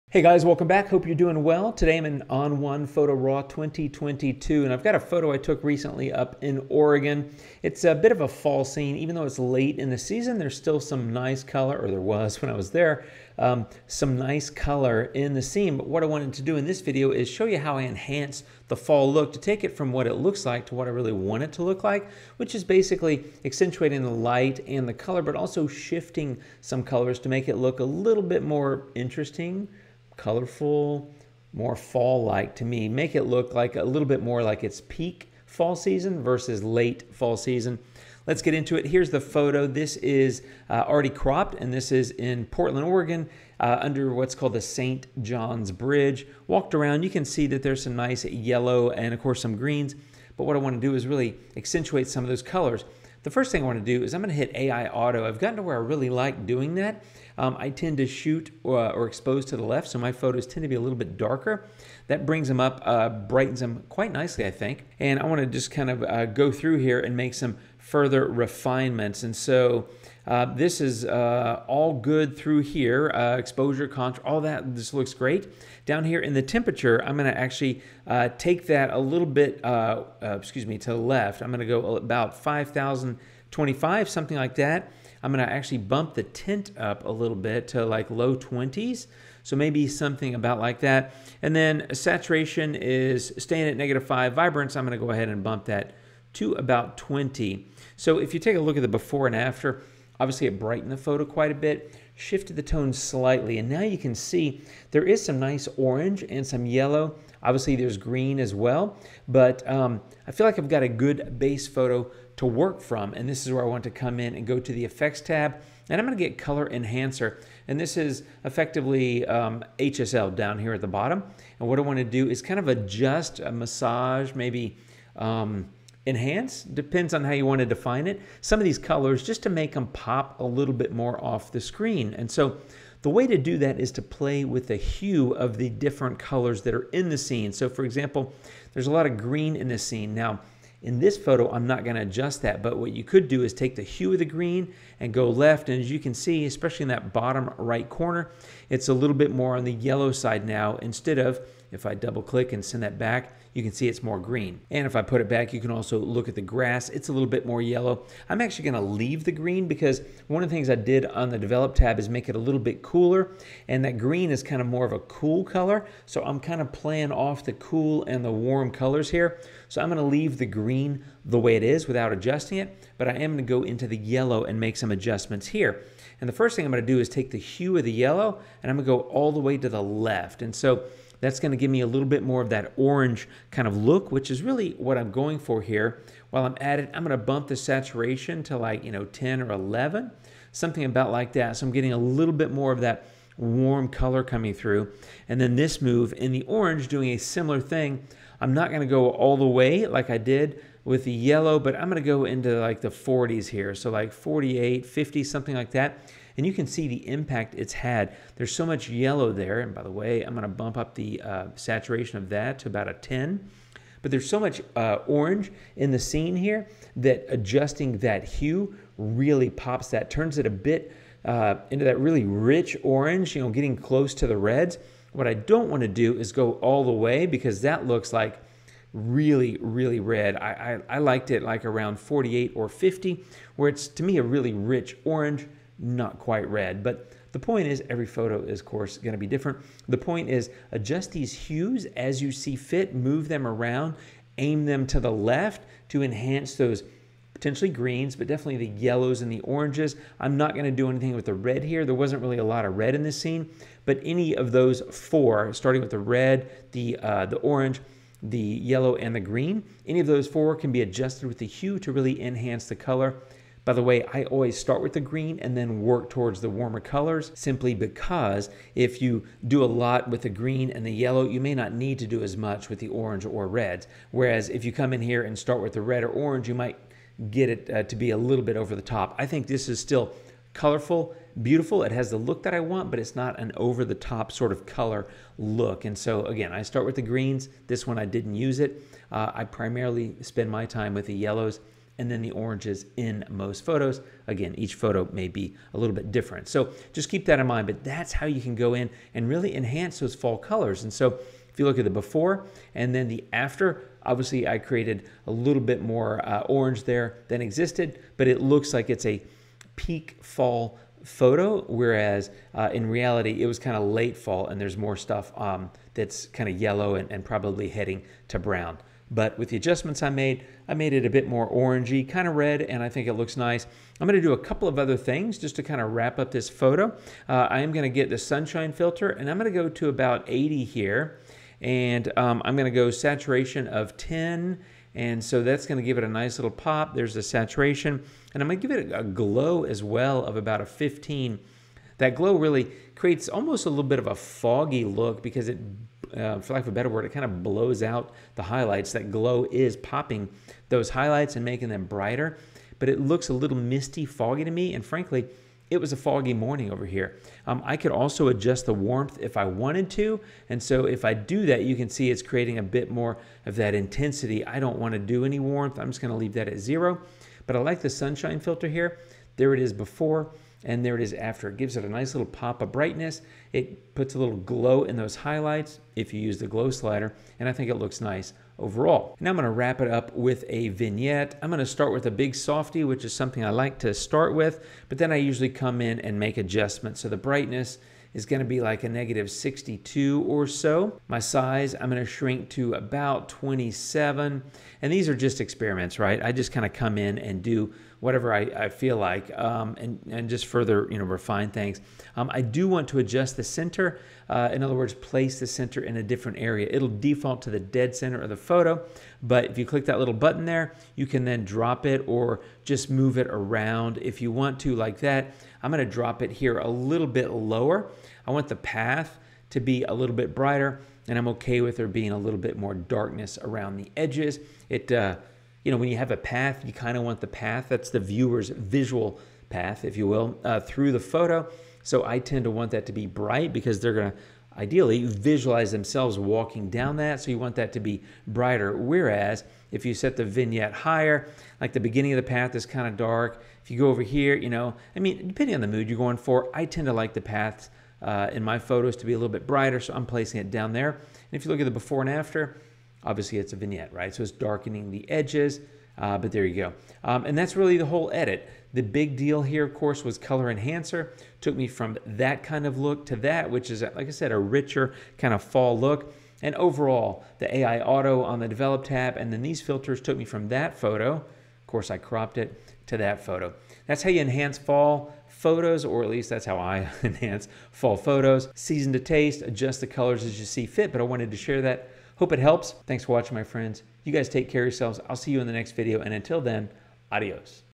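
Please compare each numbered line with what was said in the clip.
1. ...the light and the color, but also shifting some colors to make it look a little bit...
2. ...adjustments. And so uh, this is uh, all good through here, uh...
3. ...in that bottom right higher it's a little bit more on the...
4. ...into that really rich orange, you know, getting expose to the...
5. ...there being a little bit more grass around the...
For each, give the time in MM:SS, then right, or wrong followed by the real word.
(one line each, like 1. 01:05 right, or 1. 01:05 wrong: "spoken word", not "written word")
1. 00:24 right
2. 01:08 wrong: "refinements", not "adjustments"
3. 02:26 wrong: "corner", not "higher"
4. 03:41 wrong: "close", not "expose"
5. 07:01 wrong: "darkness", not "grass".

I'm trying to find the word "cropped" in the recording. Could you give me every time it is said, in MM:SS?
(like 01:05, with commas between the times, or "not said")
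00:41, 07:51.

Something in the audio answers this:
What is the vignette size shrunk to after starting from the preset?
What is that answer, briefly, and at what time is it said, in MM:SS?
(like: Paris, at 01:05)
27, at 06:32.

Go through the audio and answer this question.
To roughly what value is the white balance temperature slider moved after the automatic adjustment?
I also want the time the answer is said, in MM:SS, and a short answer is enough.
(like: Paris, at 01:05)
5,025, at 01:22.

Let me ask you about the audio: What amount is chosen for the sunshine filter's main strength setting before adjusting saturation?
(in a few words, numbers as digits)
80.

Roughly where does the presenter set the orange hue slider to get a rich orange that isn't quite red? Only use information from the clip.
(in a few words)
48 or 50.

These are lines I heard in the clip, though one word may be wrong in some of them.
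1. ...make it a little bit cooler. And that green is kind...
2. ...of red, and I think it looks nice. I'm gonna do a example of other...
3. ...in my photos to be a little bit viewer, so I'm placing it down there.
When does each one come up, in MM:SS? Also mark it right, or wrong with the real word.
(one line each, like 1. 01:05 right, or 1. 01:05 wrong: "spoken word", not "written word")
1. 02:42 right
2. 05:22 wrong: "couple", not "example"
3. 07:28 wrong: "brighter", not "viewer".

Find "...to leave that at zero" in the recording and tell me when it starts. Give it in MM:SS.
06:06.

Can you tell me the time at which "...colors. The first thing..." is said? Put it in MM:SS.
00:52.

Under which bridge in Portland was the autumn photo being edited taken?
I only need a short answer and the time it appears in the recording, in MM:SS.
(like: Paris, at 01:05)
St. John's Bridge, at 00:44.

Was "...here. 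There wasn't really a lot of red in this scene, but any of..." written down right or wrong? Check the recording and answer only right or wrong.
right.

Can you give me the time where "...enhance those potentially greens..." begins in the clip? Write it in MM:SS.
04:06.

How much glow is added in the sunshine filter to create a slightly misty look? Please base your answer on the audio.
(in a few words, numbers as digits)
15.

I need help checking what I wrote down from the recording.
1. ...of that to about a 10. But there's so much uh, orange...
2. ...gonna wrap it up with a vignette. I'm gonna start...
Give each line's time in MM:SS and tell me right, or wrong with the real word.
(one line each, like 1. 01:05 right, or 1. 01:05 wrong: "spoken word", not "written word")
1. 03:32 right
2. 06:19 right.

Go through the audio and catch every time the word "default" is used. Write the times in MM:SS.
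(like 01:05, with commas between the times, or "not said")
06:46.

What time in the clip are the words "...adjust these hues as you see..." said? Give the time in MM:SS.
04:00.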